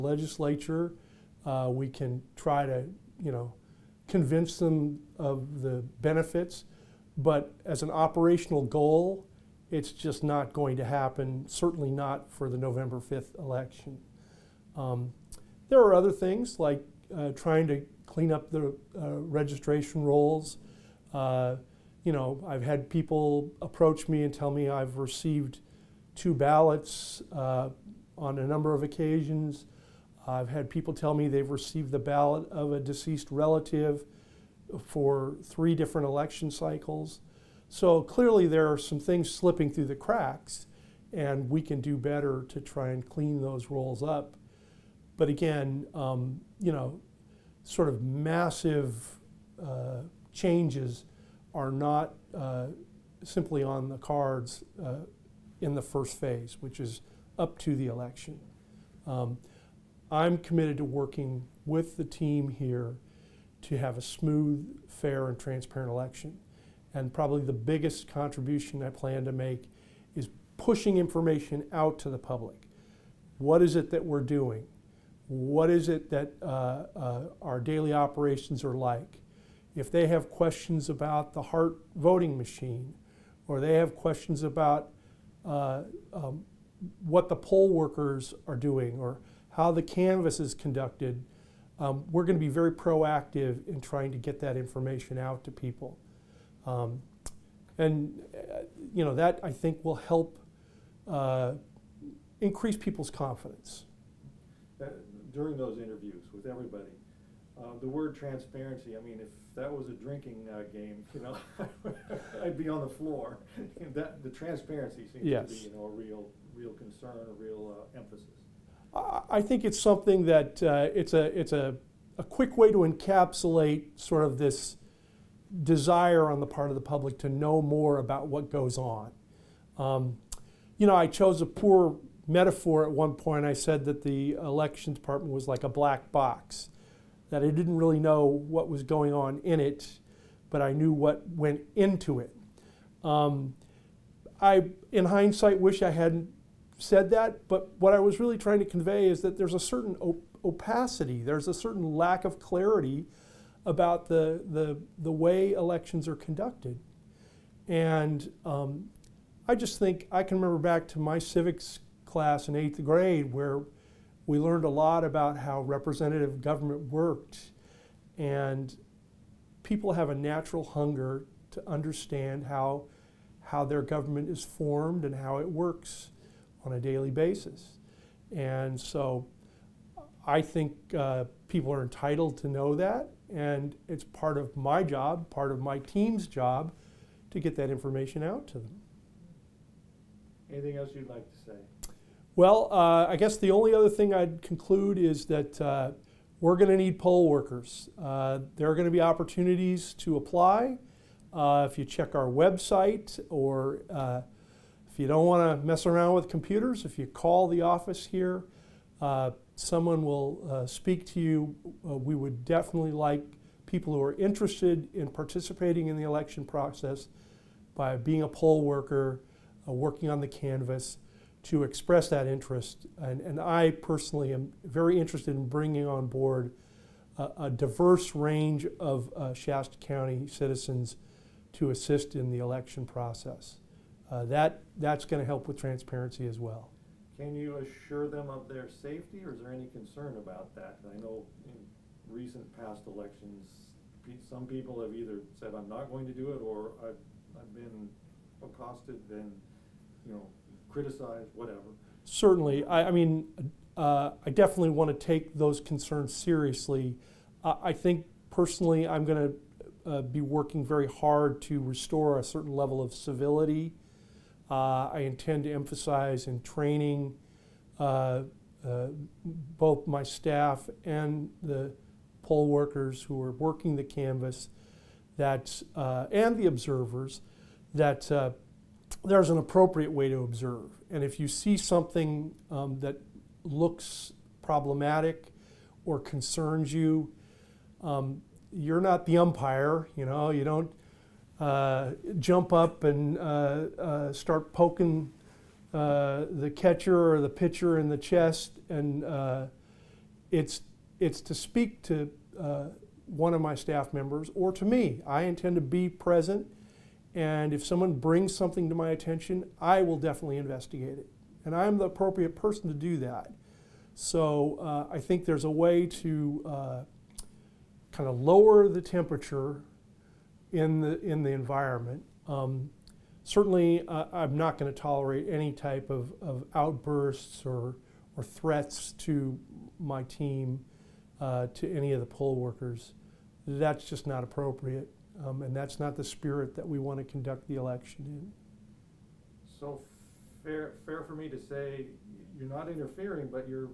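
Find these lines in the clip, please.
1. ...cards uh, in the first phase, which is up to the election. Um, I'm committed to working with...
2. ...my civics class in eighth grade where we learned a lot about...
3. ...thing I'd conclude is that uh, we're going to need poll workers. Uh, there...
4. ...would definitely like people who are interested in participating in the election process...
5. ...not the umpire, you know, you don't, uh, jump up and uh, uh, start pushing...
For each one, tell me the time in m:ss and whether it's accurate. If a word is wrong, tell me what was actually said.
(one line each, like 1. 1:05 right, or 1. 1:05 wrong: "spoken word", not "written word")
1. 0:53 right
2. 2:40 right
3. 3:13 right
4. 3:32 right
5. 4:48 wrong: "poking", not "pushing".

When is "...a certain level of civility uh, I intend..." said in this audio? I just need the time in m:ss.
4:22.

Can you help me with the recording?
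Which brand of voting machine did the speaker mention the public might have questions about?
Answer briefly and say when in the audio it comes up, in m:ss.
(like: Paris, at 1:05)
Hart, at 1:21.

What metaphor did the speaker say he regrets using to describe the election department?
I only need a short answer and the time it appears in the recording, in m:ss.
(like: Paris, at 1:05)
a black box, at 2:15.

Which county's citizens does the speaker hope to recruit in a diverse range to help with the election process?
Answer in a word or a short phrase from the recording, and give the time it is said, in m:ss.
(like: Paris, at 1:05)
Shasta County, at 3:49.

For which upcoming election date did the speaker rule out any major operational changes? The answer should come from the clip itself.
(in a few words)
November 5th.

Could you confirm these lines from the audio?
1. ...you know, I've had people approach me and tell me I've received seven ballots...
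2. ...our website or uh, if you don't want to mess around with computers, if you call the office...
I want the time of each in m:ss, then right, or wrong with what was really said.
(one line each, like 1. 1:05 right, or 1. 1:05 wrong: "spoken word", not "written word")
1. 0:22 wrong: "two", not "seven"
2. 3:22 right.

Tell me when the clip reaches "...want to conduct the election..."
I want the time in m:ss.
5:36.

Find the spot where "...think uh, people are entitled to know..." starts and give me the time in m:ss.
3:00.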